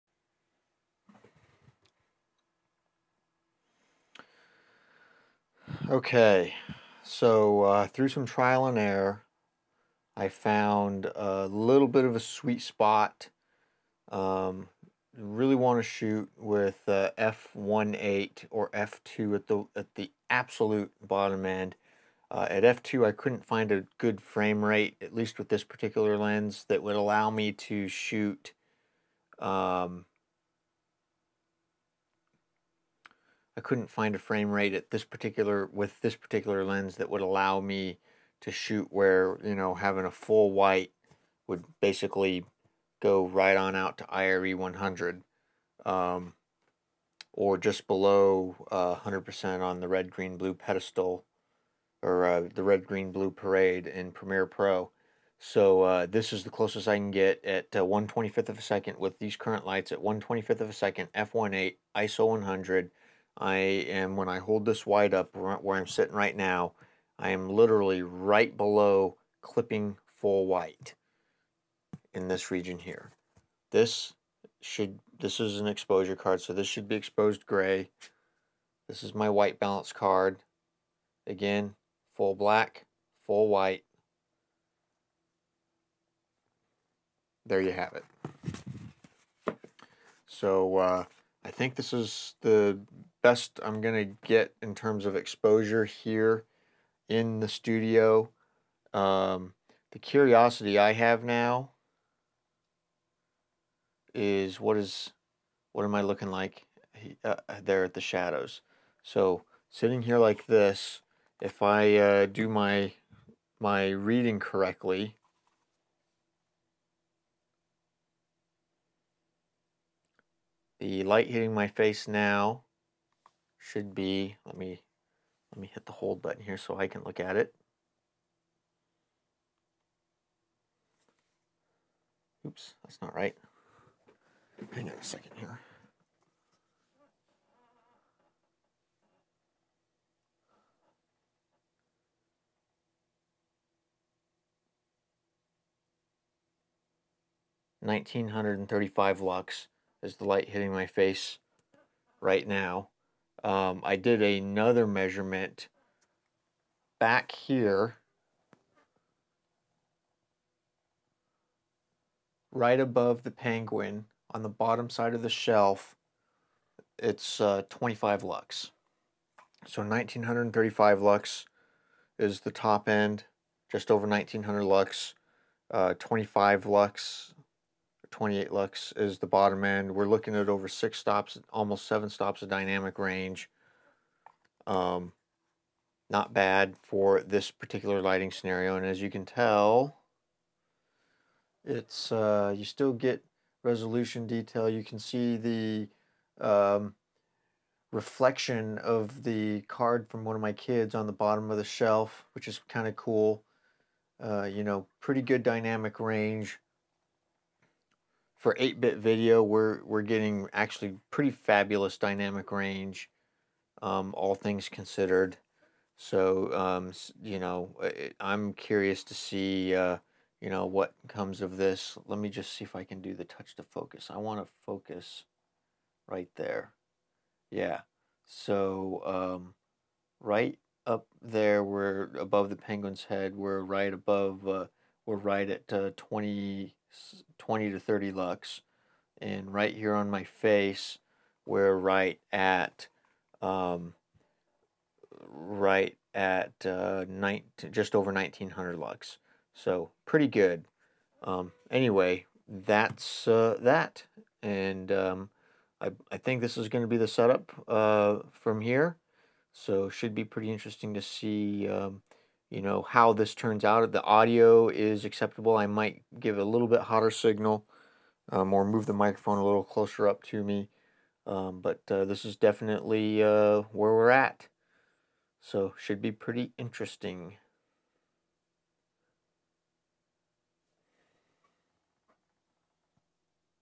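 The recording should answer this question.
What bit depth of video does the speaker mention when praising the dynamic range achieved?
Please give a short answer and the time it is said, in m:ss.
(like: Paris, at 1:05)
8-bit, at 3:28.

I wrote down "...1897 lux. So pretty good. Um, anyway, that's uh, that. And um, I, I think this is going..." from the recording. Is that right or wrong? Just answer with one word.
wrong.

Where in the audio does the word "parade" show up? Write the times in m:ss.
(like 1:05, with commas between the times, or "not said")
0:53.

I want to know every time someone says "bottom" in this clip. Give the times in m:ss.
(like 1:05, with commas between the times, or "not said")
0:21, 2:44, 2:59, 3:21.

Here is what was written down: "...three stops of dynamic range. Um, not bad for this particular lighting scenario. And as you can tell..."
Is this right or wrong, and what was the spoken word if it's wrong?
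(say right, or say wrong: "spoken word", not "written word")
wrong: "seven", not "three".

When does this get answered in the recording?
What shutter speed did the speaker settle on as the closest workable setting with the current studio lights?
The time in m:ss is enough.
0:57.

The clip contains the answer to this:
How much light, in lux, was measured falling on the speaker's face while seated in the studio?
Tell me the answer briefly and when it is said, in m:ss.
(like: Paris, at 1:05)
1935 lux, at 2:27.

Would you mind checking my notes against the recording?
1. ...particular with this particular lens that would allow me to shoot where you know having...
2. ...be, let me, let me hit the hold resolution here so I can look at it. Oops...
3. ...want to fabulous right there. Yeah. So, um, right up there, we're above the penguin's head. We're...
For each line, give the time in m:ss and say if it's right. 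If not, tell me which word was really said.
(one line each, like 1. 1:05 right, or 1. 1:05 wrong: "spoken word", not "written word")
1. 0:35 right
2. 2:03 wrong: "button", not "resolution"
3. 3:44 wrong: "focus", not "fabulous".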